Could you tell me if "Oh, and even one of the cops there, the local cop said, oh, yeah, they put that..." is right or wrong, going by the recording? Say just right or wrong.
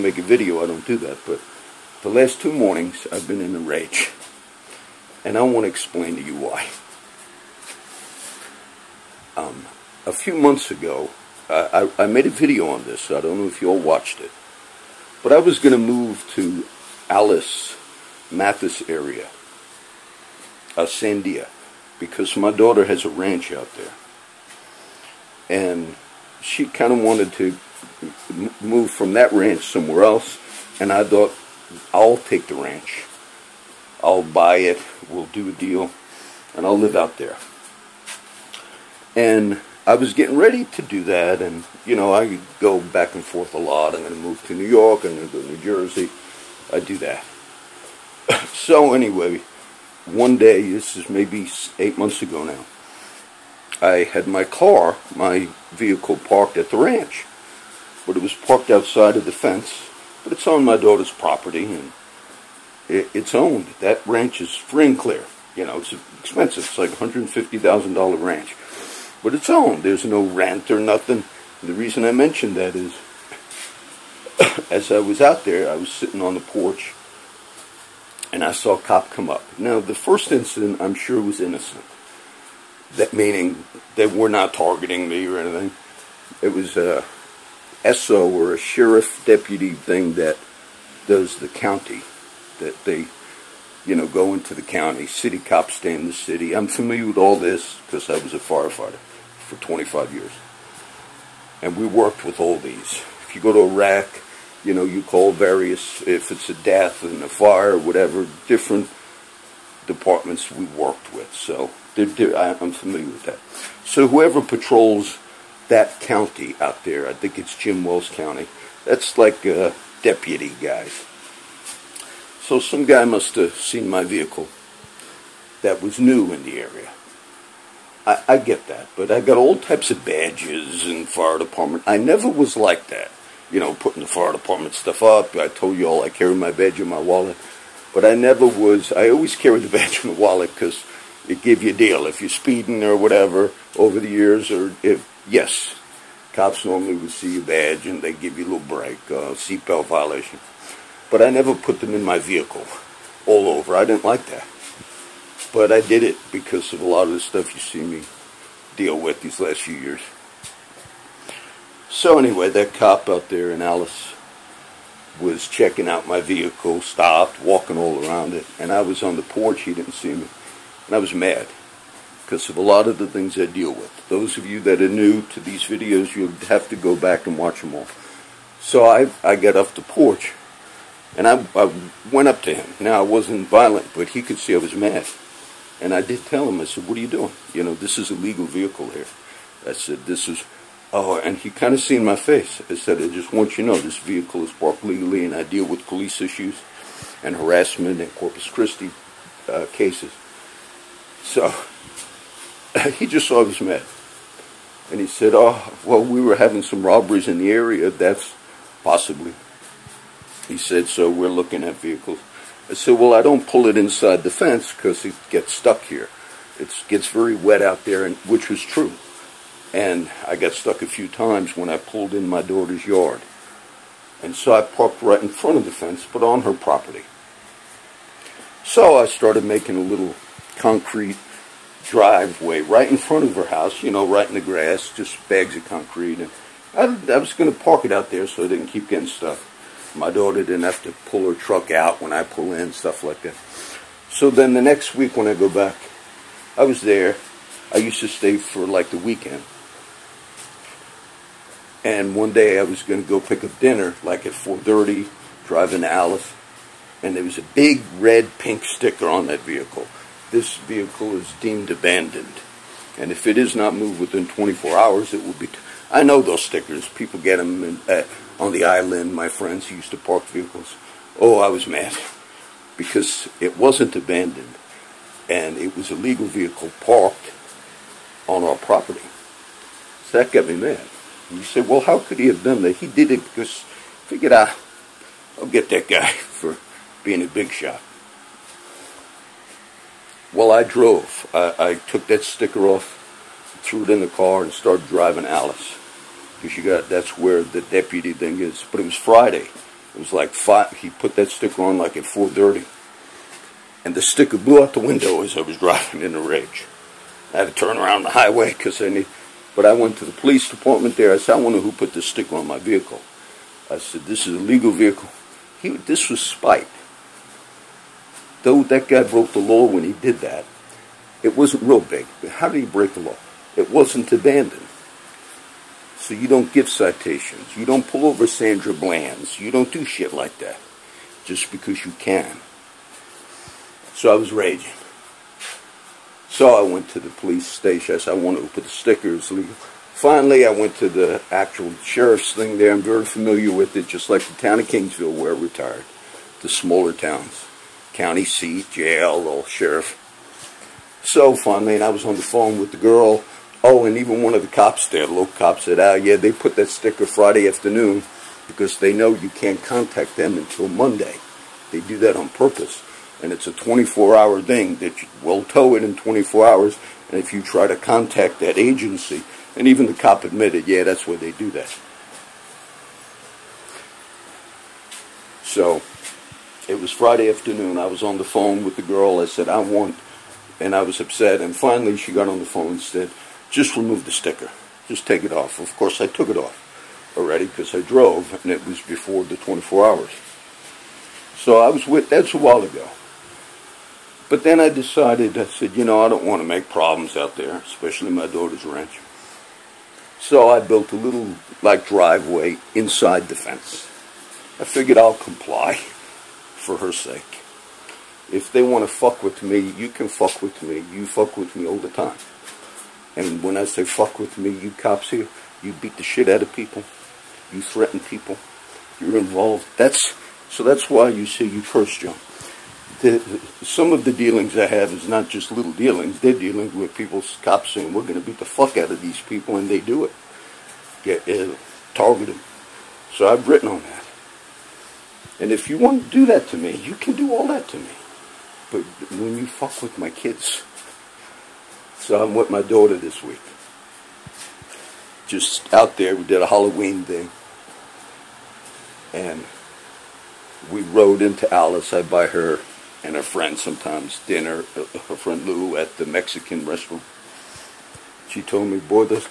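right.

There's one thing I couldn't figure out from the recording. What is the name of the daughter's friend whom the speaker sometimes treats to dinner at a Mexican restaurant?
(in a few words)
Lou.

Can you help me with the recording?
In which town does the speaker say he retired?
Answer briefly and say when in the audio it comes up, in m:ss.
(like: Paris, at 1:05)
Kingsville, at 5:44.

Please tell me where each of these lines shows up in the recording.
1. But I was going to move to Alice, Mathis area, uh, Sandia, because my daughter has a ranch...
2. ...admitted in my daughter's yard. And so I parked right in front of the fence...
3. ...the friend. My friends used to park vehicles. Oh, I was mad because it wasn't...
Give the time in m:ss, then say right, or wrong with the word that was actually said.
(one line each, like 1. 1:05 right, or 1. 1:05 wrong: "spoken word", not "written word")
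1. 0:15 right
2. 3:41 wrong: "pulled", not "admitted"
3. 4:28 wrong: "island", not "friend".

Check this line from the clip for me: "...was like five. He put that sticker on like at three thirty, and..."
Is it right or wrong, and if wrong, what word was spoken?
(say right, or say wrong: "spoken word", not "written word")
wrong: "four", not "three".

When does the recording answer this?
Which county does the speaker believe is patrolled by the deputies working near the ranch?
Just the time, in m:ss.
1:57.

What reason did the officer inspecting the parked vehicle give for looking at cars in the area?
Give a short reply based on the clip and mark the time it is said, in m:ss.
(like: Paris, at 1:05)
Robberies, at 3:26.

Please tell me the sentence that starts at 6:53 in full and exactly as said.
And when I say fuck with me, you cops here, you beat the shit out of people.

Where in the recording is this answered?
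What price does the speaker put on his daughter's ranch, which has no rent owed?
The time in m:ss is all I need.
1:06.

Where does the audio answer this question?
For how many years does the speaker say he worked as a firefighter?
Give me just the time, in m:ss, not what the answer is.
1:39.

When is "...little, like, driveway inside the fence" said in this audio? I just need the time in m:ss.
6:40.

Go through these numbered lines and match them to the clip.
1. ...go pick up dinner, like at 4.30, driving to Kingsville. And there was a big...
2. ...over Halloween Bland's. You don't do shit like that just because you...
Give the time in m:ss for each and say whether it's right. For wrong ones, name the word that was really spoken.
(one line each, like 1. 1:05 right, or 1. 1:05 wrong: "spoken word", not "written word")
1. 4:13 wrong: "Alice", not "Kingsville"
2. 5:28 wrong: "Sandra", not "Halloween".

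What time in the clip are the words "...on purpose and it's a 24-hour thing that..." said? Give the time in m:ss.
6:02.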